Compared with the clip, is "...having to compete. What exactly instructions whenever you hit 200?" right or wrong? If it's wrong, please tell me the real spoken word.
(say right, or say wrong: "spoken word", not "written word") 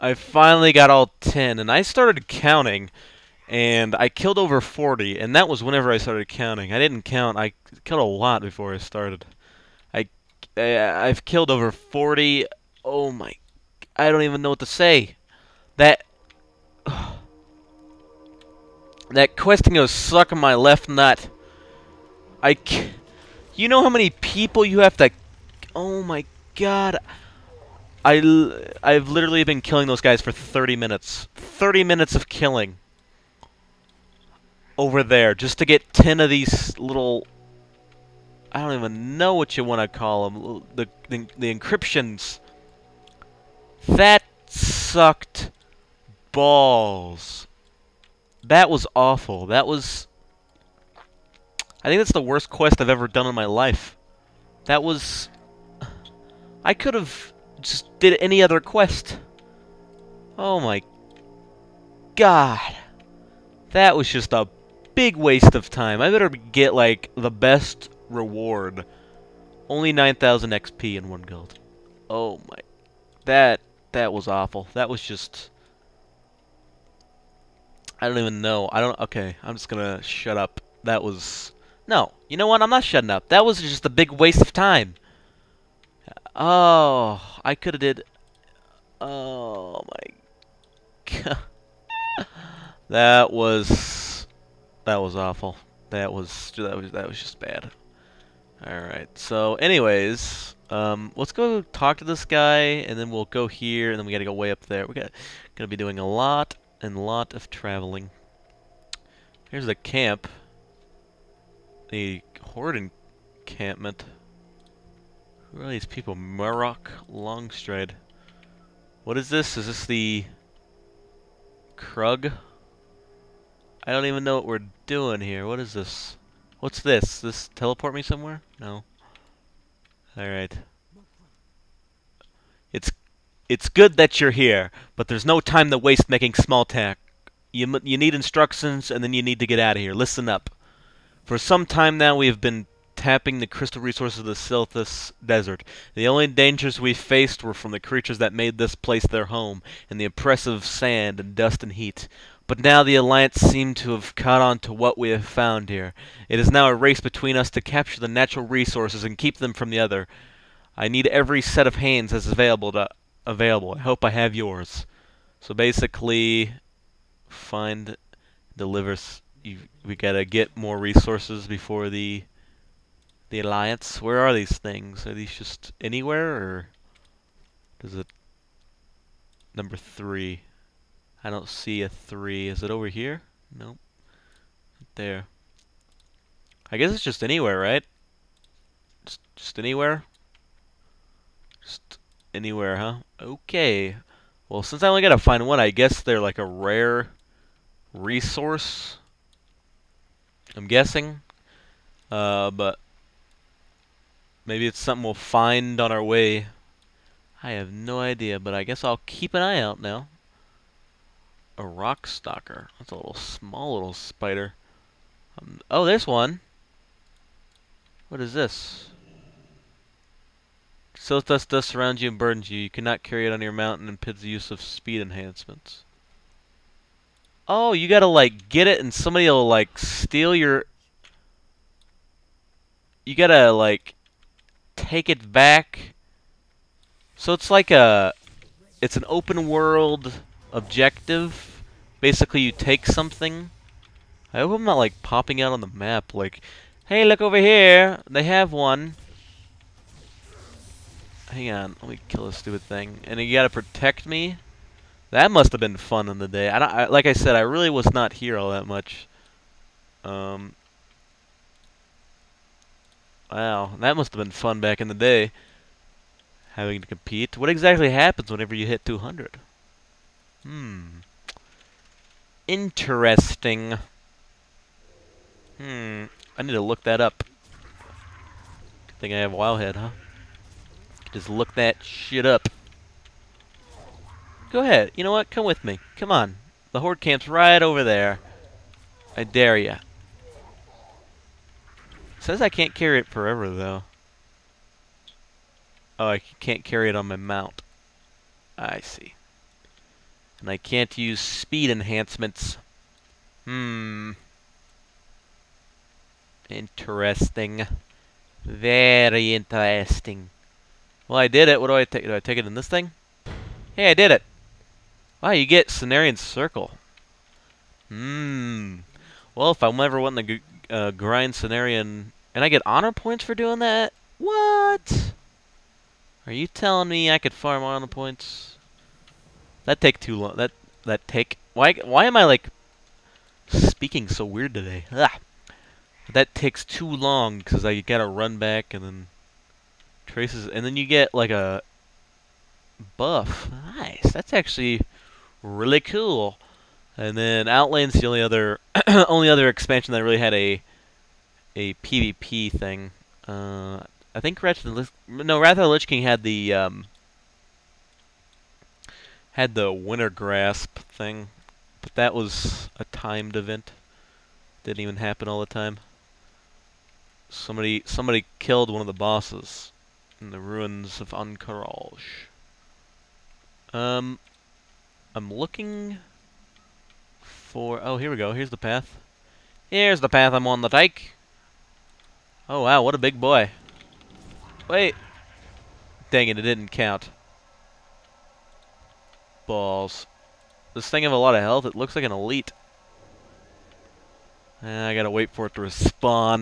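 wrong: "happens", not "instructions".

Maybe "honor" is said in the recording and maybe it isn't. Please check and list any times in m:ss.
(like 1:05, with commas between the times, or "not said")
5:22, 5:27.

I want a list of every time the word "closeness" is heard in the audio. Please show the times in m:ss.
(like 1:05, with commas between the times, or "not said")
not said.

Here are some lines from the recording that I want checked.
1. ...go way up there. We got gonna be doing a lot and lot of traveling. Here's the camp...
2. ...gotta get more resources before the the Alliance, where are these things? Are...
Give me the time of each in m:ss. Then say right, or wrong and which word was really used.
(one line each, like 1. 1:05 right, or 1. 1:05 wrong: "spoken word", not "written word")
1. 1:44 right
2. 2:49 right.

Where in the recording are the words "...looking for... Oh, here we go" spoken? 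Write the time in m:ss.
6:15.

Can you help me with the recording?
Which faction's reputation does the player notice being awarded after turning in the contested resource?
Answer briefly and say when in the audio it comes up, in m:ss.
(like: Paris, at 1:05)
Cenarion Circle, at 5:15.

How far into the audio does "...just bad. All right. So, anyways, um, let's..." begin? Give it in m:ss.
1:37.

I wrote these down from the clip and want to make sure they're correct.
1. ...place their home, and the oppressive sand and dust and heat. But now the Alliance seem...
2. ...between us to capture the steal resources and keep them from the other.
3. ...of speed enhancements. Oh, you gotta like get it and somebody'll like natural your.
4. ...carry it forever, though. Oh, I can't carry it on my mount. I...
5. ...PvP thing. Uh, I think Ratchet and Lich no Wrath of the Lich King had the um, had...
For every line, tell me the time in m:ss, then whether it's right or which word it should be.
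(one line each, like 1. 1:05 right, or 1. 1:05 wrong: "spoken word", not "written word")
1. 2:28 right
2. 2:37 wrong: "natural", not "steal"
3. 3:44 wrong: "steal", not "natural"
4. 4:52 right
5. 5:51 right.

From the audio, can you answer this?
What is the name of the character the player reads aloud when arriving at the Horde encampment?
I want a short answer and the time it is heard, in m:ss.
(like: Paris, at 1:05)
Murrock Longstride, at 1:56.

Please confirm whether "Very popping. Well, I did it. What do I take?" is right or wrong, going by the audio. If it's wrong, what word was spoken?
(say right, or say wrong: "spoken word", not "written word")
wrong: "interesting", not "popping".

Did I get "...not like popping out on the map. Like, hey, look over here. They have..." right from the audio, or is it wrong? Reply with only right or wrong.
right.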